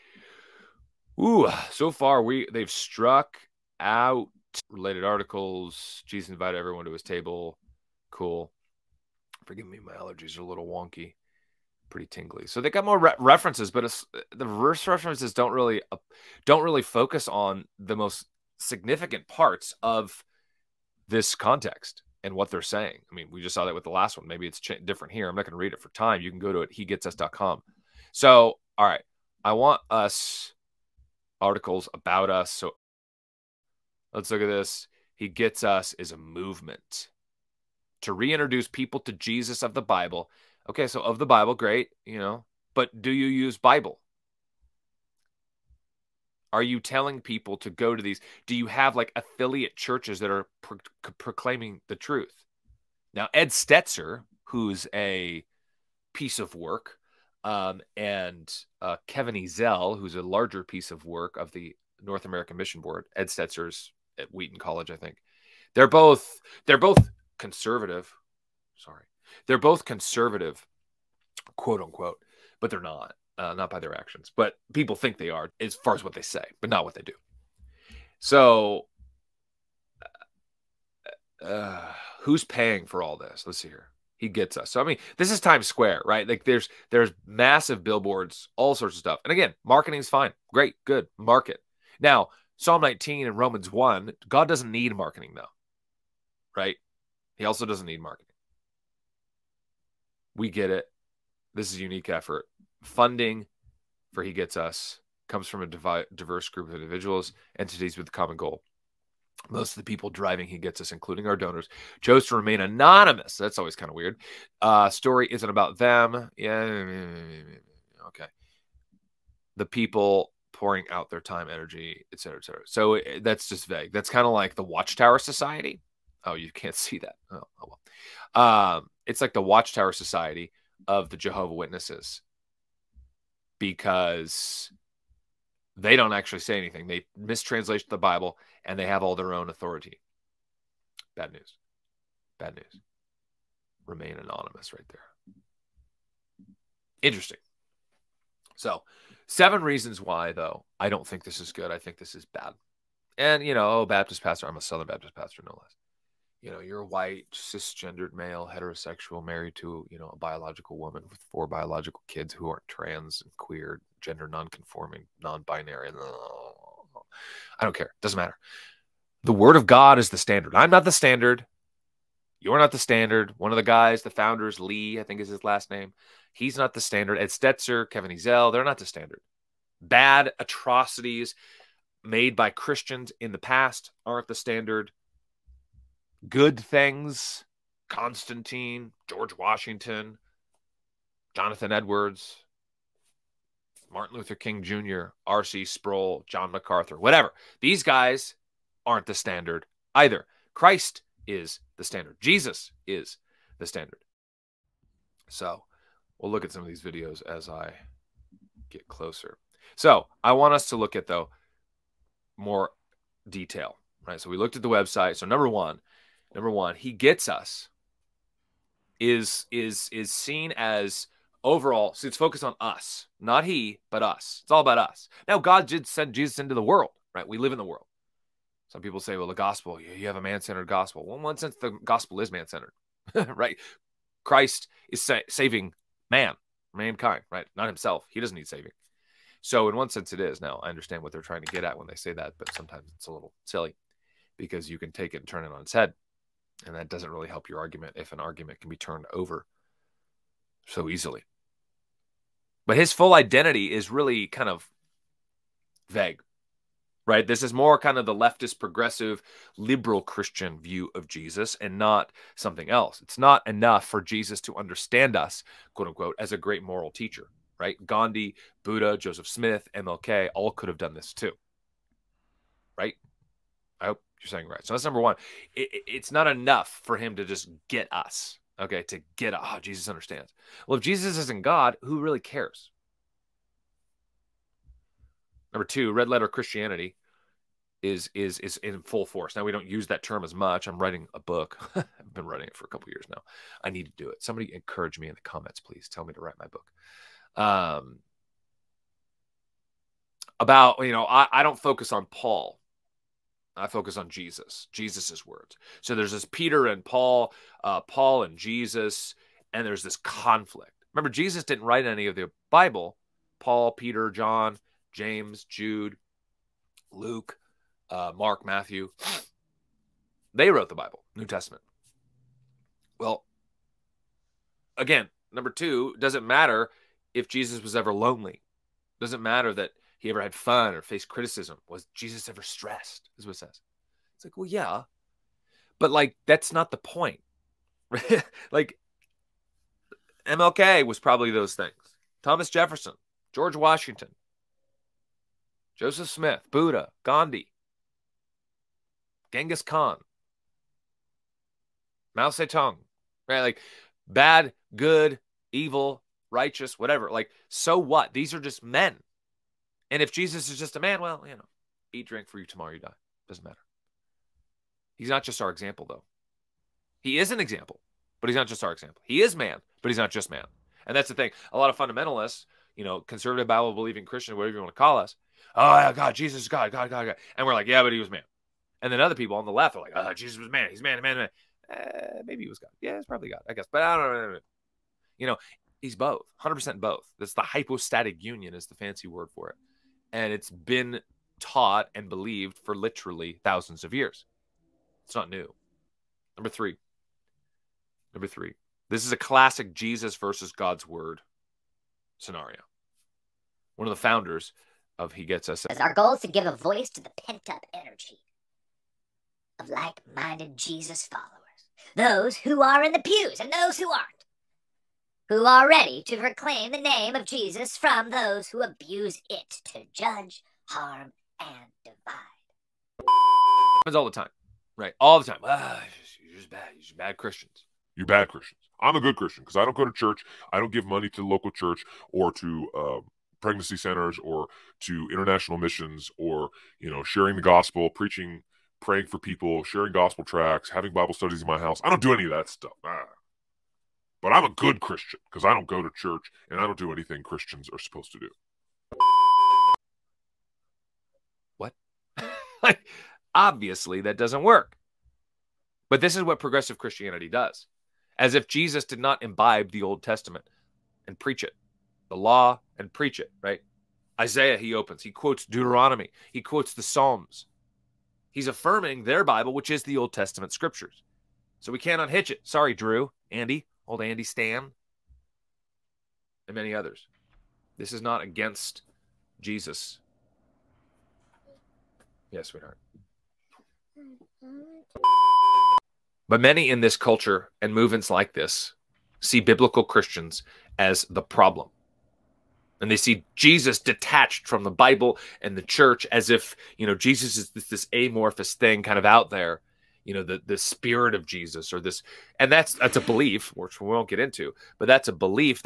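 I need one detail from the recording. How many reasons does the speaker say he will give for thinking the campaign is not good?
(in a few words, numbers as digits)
7.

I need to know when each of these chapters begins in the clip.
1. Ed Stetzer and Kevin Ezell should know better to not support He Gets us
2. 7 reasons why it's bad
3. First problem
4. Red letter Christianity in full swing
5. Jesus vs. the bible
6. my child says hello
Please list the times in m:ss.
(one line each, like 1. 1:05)
1. 0:42
2. 2:28
3. 3:43
4. 4:44
5. 6:35
6. 8:02.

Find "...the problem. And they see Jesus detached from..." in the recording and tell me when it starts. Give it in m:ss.
8:11.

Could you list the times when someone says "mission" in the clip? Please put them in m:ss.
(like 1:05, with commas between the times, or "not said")
1:02, 7:15.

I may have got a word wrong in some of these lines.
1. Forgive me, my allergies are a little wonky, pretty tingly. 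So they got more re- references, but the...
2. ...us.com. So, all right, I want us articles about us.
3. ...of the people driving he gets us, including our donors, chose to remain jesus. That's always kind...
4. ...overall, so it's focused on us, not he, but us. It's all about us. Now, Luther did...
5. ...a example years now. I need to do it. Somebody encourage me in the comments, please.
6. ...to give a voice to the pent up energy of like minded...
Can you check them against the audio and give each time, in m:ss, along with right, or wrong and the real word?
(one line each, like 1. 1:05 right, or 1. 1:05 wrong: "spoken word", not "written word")
1. 0:09 right
2. 0:27 right
3. 1:49 wrong: "anonymous", not "jesus"
4. 3:41 wrong: "God", not "Luther"
5. 4:52 wrong: "couple", not "example"
6. 6:46 right.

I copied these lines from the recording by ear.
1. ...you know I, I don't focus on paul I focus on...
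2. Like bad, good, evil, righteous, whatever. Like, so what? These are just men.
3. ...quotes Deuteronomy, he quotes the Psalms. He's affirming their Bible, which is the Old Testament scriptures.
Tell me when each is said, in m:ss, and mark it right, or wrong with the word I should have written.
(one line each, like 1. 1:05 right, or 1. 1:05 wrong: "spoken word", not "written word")
1. 5:00 right
2. 5:53 right
3. 7:45 right.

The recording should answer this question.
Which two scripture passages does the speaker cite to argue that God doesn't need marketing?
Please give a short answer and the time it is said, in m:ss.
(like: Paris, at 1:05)
Psalm 19 and Romans 1, at 1:32.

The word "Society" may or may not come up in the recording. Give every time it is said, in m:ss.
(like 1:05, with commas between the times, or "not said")
2:05, 2:09.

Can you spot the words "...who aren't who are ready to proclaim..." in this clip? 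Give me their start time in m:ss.
6:53.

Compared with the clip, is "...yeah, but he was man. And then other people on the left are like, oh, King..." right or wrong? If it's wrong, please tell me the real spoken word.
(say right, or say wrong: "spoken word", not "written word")
wrong: "Jesus", not "King".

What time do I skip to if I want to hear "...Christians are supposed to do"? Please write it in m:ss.
7:27.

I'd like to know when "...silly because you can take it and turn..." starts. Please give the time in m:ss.
4:03.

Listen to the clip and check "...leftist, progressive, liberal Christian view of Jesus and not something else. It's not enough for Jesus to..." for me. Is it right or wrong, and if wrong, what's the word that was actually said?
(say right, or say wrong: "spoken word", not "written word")
right.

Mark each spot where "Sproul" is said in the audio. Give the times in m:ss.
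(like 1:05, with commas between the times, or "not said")
3:15.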